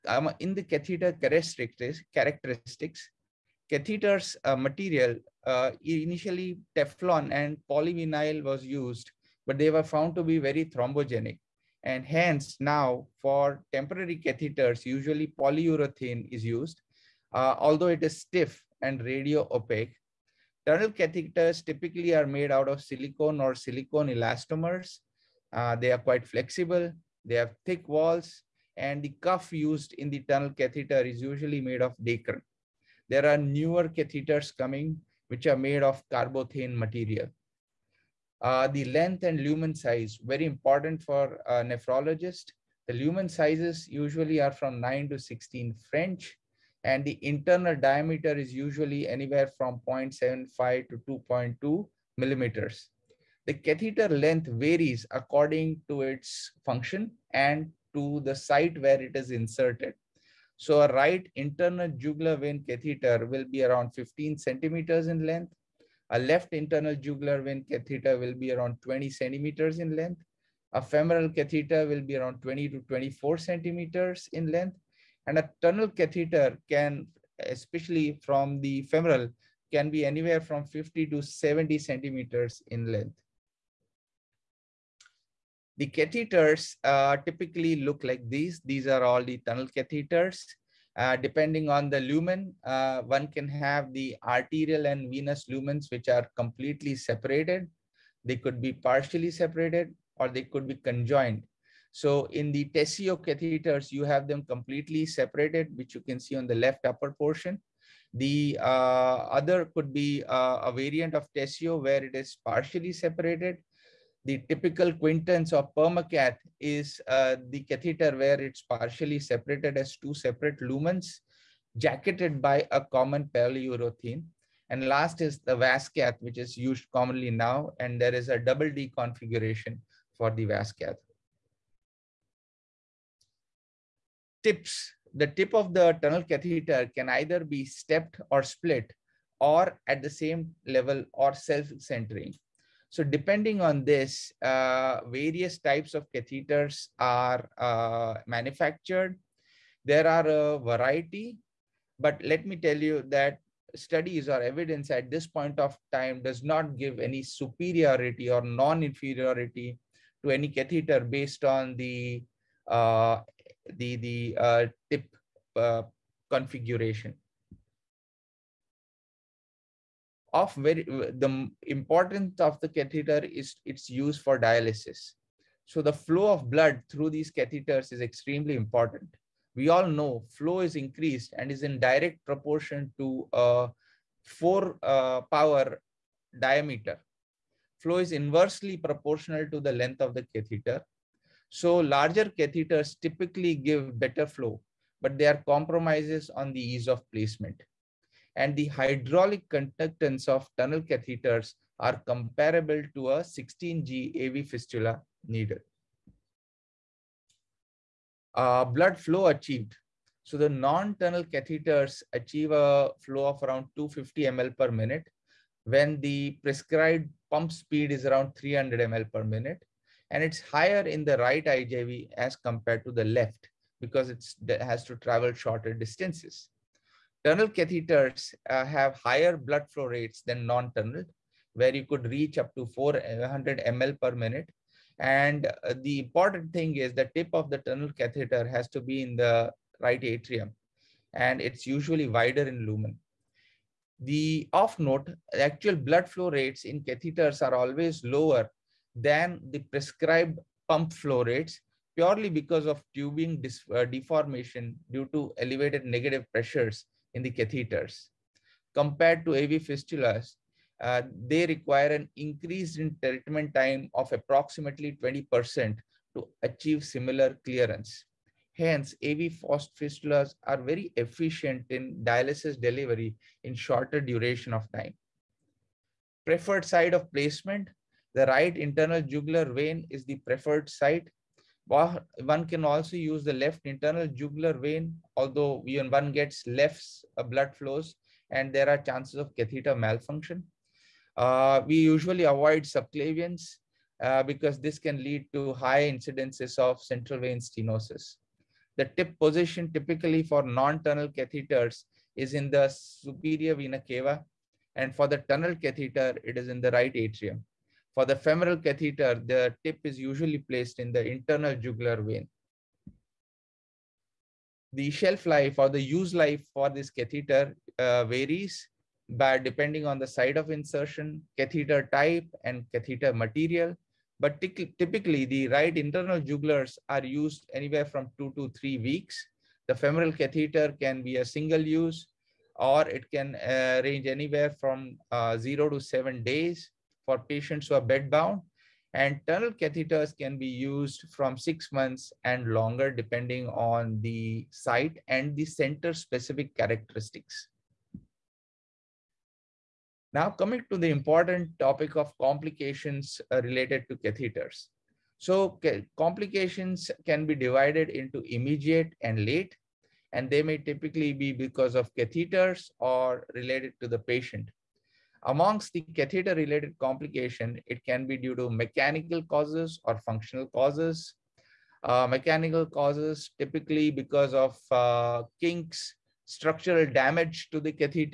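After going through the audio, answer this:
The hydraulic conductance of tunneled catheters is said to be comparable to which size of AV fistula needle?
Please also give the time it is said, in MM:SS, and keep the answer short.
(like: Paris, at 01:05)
16G, at 03:23.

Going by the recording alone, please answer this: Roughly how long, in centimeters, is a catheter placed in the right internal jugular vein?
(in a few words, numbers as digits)
15 centimeters.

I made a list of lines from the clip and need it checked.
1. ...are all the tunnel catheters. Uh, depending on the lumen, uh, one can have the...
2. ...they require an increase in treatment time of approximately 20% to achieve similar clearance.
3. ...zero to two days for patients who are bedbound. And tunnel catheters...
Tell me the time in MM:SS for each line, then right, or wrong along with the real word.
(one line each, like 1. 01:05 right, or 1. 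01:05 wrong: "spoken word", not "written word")
1. 01:28 right
2. 04:21 right
3. 05:35 wrong: "seven", not "two".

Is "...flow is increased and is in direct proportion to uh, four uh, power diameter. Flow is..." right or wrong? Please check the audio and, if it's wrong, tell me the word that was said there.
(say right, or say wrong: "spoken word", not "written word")
right.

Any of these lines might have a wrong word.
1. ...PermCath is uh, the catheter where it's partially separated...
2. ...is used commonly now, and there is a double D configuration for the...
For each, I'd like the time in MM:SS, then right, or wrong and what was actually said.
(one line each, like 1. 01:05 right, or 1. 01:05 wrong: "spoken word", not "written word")
1. 01:55 right
2. 02:06 right.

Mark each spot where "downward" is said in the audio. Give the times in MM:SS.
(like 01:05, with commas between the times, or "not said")
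not said.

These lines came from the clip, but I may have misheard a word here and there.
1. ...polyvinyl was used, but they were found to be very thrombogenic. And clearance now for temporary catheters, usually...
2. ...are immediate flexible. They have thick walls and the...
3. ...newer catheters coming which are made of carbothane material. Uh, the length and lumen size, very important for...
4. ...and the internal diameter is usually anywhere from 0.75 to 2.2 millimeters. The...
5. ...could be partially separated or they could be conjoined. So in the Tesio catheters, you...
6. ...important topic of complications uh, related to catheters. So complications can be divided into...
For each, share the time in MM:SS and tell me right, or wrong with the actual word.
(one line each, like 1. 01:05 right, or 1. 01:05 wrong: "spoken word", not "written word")
1. 00:07 wrong: "hence", not "clearance"
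2. 00:25 wrong: "quite", not "immediate"
3. 00:33 right
4. 00:46 right
5. 01:38 right
6. 05:50 right.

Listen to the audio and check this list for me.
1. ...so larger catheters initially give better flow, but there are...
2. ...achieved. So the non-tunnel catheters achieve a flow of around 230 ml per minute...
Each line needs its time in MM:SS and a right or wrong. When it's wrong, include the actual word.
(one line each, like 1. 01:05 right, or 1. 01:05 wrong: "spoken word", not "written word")
1. 03:11 wrong: "typically", not "initially"
2. 03:29 wrong: "250", not "230".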